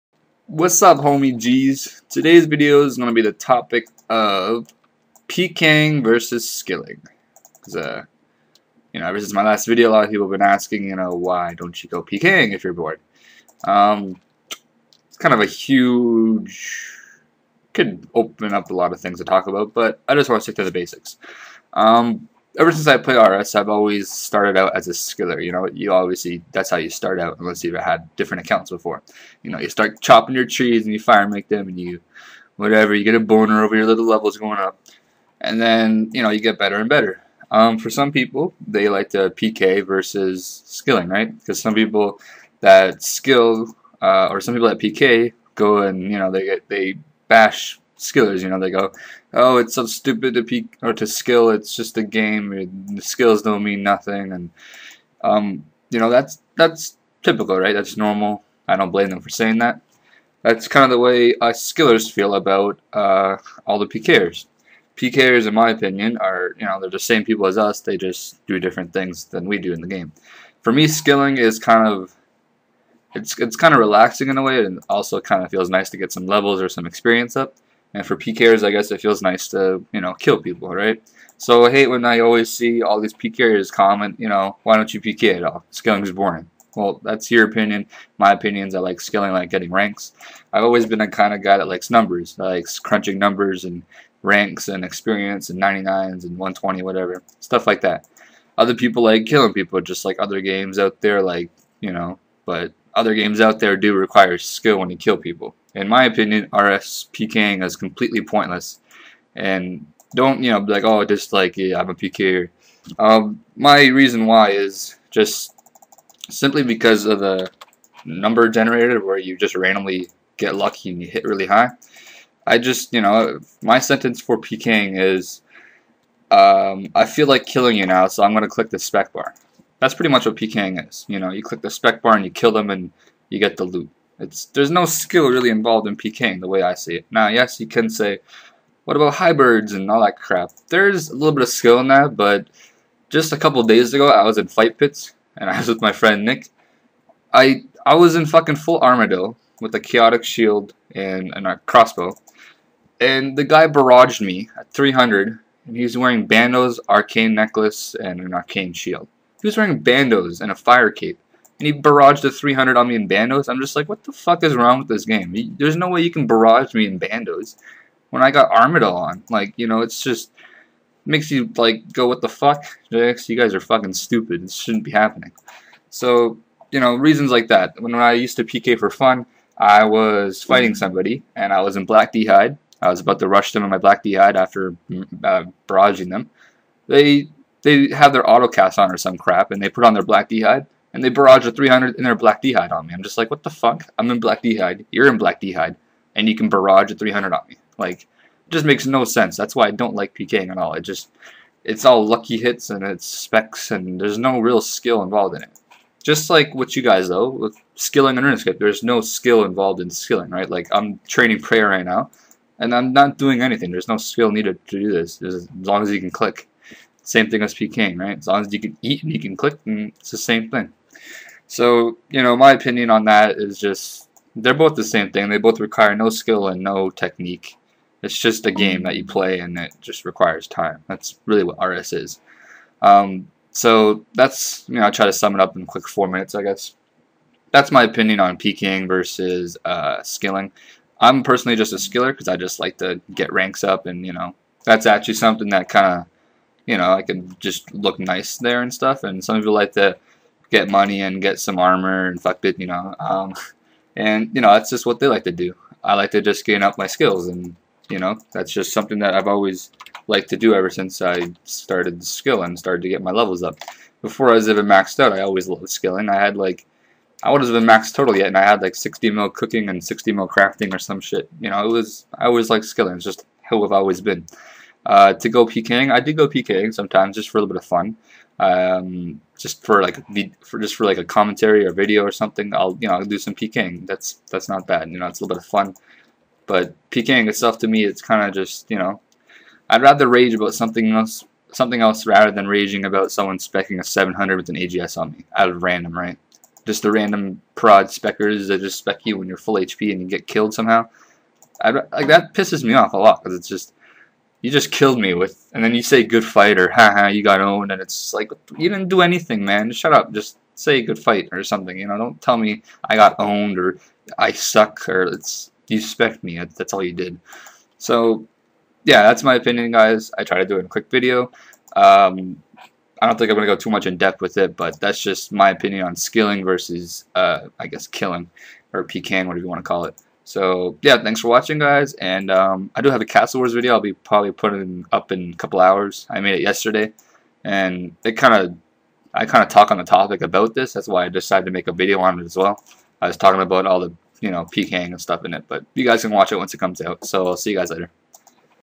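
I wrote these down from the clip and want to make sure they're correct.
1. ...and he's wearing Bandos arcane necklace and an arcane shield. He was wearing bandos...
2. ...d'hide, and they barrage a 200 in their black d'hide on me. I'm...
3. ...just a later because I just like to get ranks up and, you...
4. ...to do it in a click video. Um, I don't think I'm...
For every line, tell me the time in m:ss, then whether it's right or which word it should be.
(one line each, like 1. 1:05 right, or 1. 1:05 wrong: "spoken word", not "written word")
1. 2:35 right
2. 3:10 wrong: "300", not "200"
3. 4:01 wrong: "skiller", not "later"
4. 5:20 wrong: "quick", not "click".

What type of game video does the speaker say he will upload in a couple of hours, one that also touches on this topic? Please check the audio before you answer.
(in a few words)
Castle Wars.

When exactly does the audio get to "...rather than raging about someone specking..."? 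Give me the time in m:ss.
4:52.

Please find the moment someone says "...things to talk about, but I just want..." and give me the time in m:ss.
0:18.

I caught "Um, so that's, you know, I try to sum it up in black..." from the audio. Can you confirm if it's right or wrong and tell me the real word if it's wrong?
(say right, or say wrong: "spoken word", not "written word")
wrong: "quick", not "black".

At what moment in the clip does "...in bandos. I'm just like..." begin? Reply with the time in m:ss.
2:42.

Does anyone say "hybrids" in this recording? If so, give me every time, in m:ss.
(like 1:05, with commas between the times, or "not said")
2:19.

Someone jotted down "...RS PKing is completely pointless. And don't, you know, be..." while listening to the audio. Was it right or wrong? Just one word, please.
right.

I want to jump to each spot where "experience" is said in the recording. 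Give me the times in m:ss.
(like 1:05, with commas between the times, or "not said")
1:16, 1:34.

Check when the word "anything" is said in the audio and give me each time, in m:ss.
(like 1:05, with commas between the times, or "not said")
3:33, 5:09.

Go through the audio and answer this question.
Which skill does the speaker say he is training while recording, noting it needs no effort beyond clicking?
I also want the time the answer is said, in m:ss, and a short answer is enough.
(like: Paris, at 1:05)
Prayer, at 3:31.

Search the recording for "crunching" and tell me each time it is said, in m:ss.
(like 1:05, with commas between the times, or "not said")
1:32.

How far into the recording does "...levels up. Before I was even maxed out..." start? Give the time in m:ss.
4:23.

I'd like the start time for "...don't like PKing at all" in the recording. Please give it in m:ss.
3:19.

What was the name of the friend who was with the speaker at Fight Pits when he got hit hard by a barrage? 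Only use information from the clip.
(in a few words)
Nick.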